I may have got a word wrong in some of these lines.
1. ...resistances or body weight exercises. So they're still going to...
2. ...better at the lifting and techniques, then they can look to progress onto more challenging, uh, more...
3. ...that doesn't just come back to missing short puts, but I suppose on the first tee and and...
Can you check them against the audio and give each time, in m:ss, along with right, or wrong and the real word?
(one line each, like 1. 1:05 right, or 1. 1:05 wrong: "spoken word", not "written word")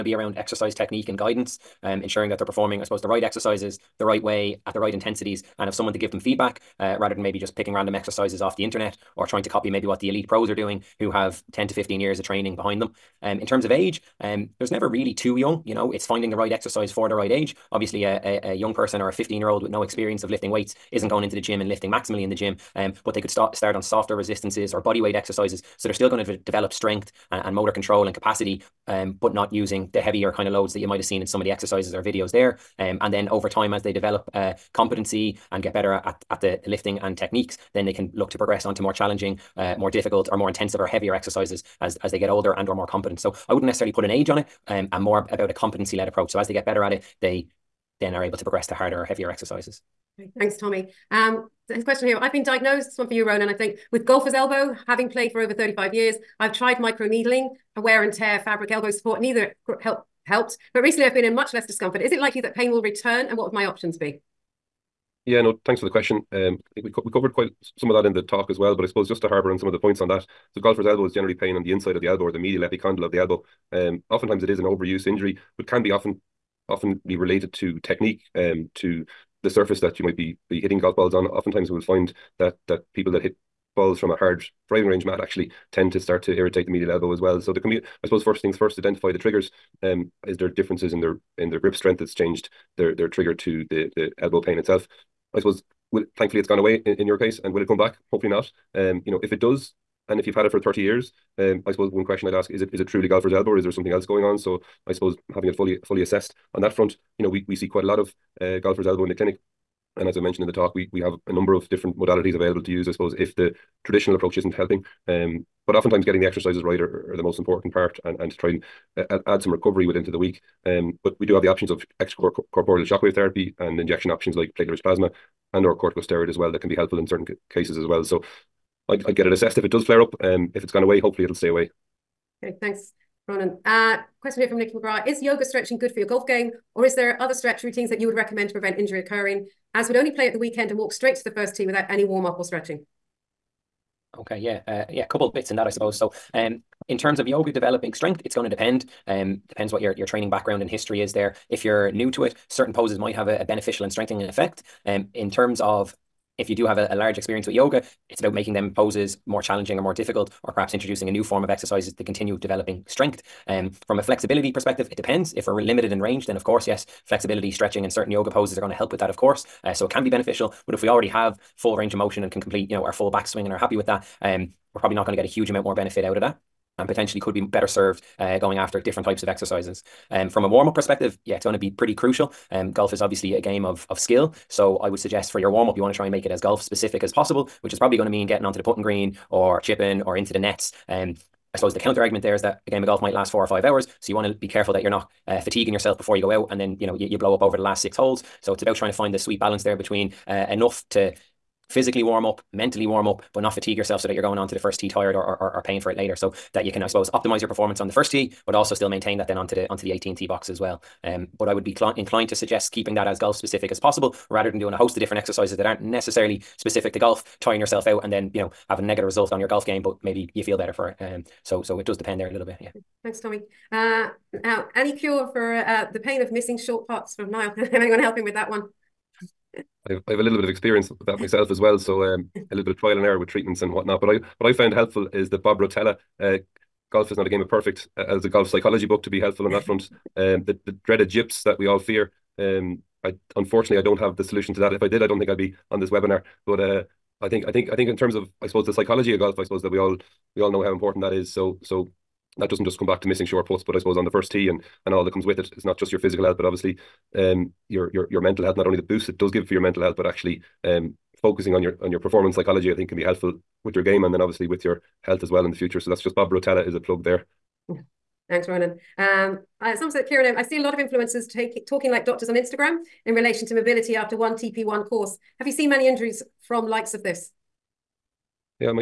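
1. 0:24 right
2. 0:35 right
3. 4:12 right.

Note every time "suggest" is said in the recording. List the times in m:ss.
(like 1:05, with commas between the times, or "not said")
3:04, 3:32.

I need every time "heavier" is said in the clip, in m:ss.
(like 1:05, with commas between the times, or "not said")
0:29, 0:40, 0:49.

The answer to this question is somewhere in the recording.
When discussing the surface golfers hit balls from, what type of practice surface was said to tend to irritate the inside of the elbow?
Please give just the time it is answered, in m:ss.
1:24.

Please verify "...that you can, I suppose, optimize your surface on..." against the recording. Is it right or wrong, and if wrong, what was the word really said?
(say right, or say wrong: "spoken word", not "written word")
wrong: "performance", not "surface".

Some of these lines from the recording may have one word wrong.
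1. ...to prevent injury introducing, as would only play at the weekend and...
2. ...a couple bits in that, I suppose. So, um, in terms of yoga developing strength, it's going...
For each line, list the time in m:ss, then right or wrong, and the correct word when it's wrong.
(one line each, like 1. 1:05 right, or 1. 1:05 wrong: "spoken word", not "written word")
1. 2:18 wrong: "occurring", not "introducing"
2. 2:25 right.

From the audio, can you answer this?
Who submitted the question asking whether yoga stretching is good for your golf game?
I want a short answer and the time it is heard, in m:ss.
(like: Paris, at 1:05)
Nikki McGrath, at 2:14.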